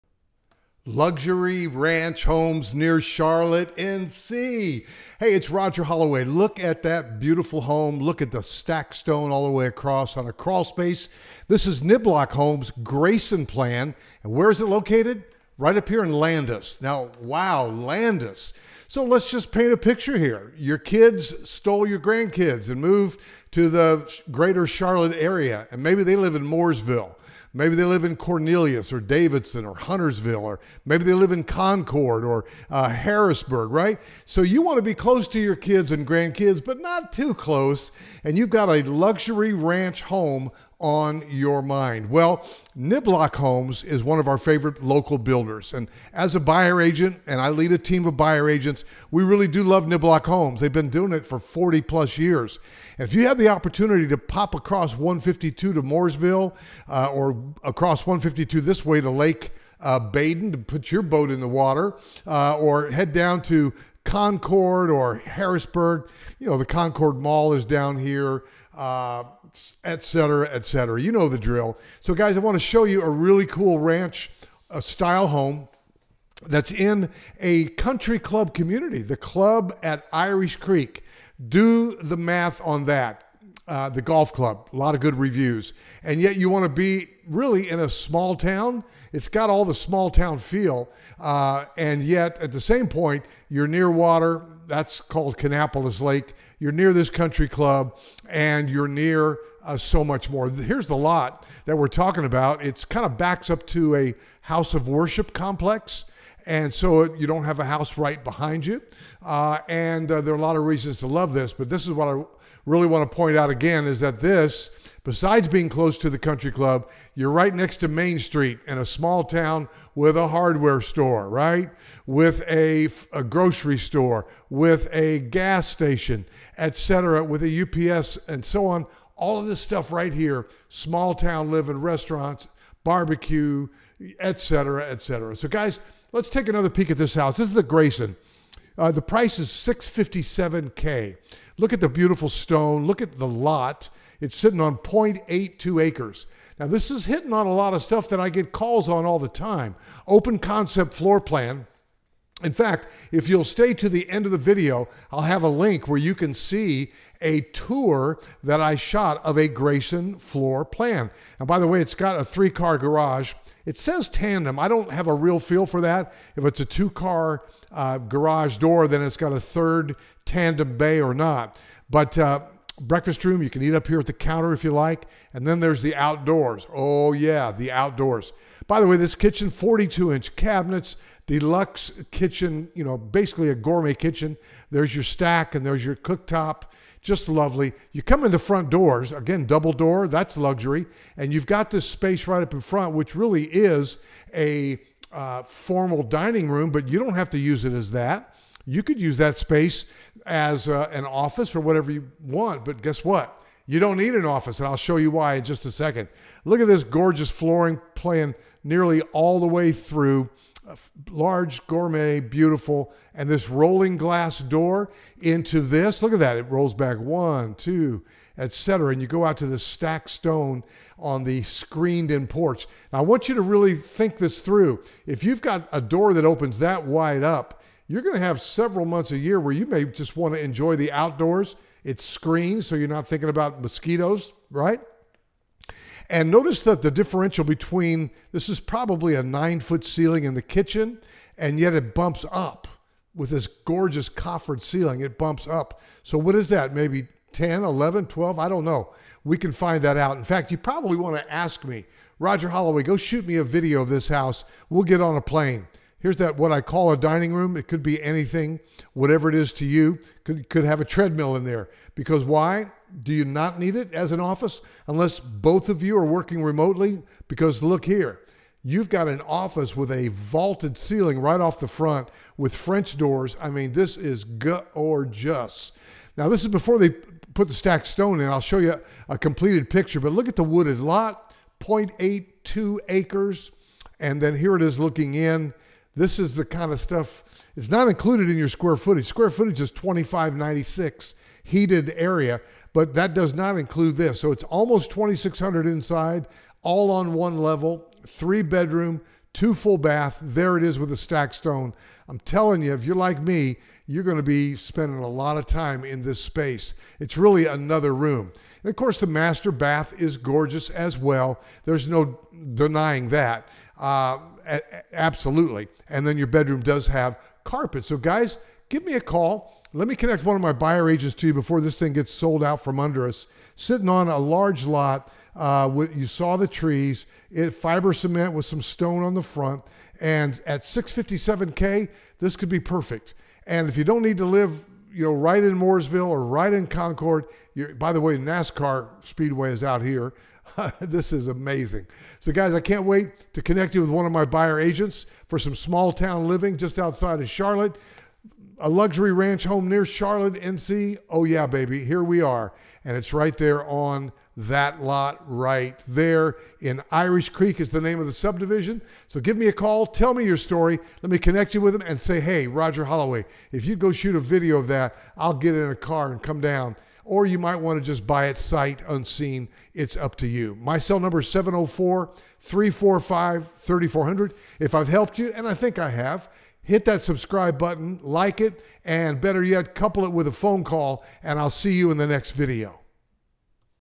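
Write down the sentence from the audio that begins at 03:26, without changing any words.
Look at this gorgeous flooring playing nearly all the way through.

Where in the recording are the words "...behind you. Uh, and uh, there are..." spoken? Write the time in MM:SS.
01:48.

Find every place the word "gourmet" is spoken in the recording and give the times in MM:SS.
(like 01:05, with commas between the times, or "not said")
03:03, 03:31.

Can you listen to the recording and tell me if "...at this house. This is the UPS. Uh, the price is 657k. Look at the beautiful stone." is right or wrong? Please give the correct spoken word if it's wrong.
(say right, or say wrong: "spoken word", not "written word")
wrong: "Grayson", not "UPS".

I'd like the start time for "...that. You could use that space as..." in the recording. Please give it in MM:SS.
03:17.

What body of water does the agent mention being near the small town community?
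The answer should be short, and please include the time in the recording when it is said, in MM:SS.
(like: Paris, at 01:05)
Kannapolis Lake, at 01:35.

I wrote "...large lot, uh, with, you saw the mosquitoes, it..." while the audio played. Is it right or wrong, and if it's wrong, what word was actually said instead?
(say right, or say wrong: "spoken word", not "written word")
wrong: "trees", not "mosquitoes".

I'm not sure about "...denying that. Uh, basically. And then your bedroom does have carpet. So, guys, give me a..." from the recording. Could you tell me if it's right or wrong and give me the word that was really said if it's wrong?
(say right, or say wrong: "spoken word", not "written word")
wrong: "absolutely", not "basically".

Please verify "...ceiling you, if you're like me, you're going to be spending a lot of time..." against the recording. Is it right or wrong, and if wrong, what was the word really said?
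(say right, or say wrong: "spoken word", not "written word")
wrong: "telling", not "ceiling".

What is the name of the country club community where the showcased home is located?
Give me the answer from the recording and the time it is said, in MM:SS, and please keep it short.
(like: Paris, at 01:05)
The Club at Irish Creek, at 01:19.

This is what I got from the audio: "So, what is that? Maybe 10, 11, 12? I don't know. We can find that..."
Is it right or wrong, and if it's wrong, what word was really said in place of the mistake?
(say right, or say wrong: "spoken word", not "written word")
right.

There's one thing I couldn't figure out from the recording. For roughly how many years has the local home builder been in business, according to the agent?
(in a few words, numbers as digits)
40 plus years.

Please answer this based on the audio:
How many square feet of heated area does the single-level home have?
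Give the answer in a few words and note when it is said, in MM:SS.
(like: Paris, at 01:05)
2596, at 04:49.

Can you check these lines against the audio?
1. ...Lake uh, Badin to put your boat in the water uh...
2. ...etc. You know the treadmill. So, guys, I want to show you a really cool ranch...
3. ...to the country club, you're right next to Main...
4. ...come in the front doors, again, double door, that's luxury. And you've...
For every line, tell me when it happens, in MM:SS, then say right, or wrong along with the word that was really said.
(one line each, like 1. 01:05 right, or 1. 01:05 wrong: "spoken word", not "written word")
1. 00:59 right
2. 01:10 wrong: "drill", not "treadmill"
3. 01:55 right
4. 03:08 right.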